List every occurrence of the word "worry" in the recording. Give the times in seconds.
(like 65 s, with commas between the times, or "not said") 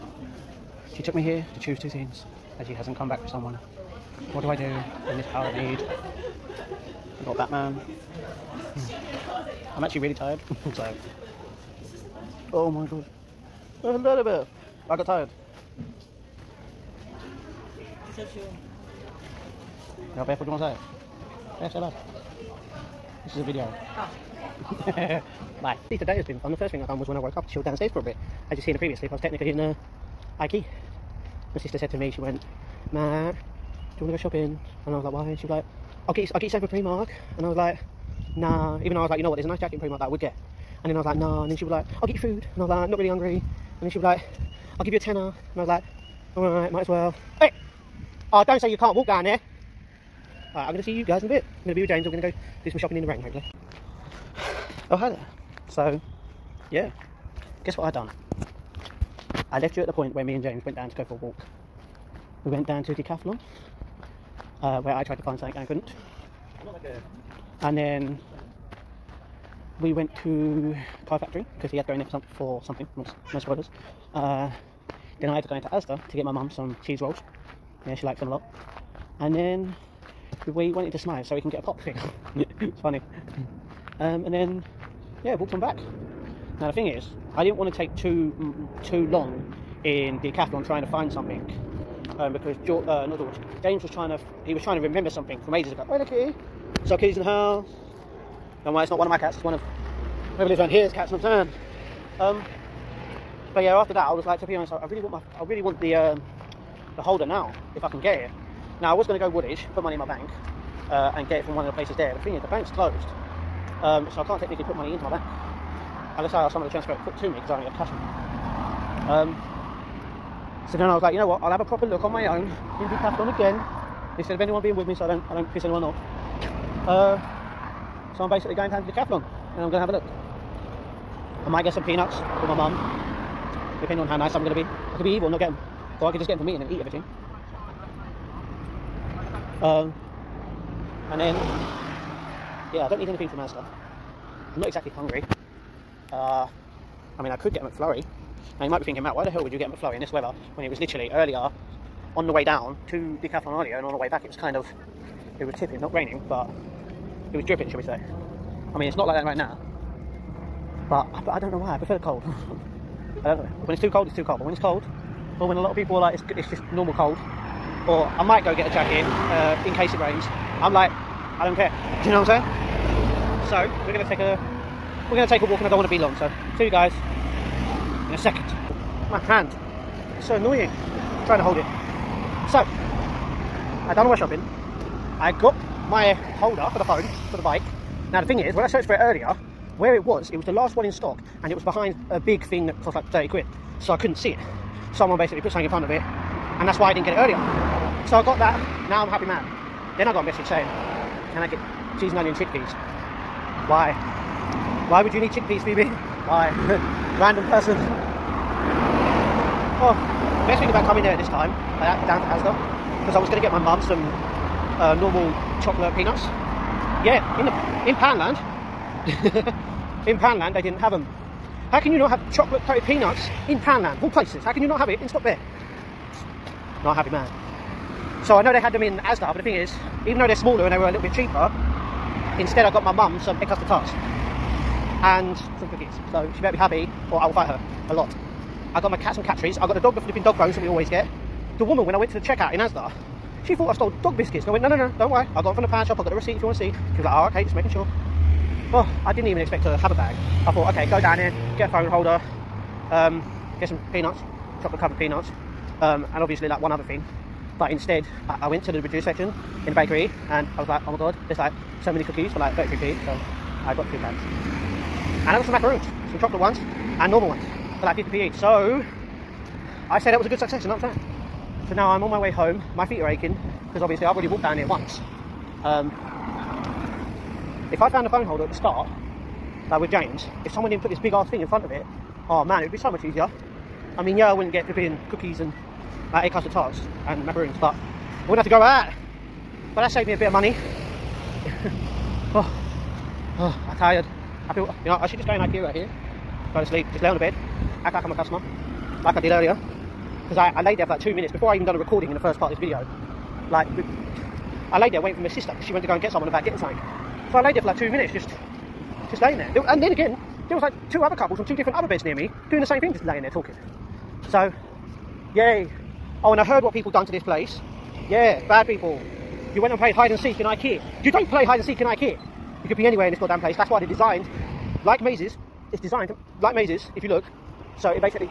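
98 s, 245 s.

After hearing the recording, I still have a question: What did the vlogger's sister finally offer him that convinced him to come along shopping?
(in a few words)
a tenner.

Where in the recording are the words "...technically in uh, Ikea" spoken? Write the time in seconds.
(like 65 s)
29 s.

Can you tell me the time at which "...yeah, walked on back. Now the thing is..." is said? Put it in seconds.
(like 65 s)
85 s.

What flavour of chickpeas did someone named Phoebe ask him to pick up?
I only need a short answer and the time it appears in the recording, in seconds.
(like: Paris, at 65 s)
cheese and onion, at 202 s.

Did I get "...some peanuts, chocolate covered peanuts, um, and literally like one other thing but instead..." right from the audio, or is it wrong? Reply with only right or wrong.
wrong.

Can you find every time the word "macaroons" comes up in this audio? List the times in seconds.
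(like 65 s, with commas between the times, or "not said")
265 s, 287 s.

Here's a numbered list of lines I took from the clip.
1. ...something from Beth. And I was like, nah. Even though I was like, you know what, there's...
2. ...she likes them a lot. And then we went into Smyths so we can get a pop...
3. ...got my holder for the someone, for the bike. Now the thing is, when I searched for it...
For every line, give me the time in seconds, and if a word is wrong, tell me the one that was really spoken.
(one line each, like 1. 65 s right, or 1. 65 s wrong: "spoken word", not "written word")
1. 36 s wrong: "Primark", not "Beth"
2. 77 s right
3. 185 s wrong: "phone", not "someone".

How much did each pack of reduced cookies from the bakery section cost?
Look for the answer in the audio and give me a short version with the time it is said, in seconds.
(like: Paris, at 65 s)
33p, at 262 s.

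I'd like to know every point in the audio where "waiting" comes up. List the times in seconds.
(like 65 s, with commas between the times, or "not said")
304 s.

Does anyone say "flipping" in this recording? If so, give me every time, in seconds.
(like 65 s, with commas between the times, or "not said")
240 s, 284 s.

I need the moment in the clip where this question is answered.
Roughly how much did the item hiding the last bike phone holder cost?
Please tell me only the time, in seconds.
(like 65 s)
193 s.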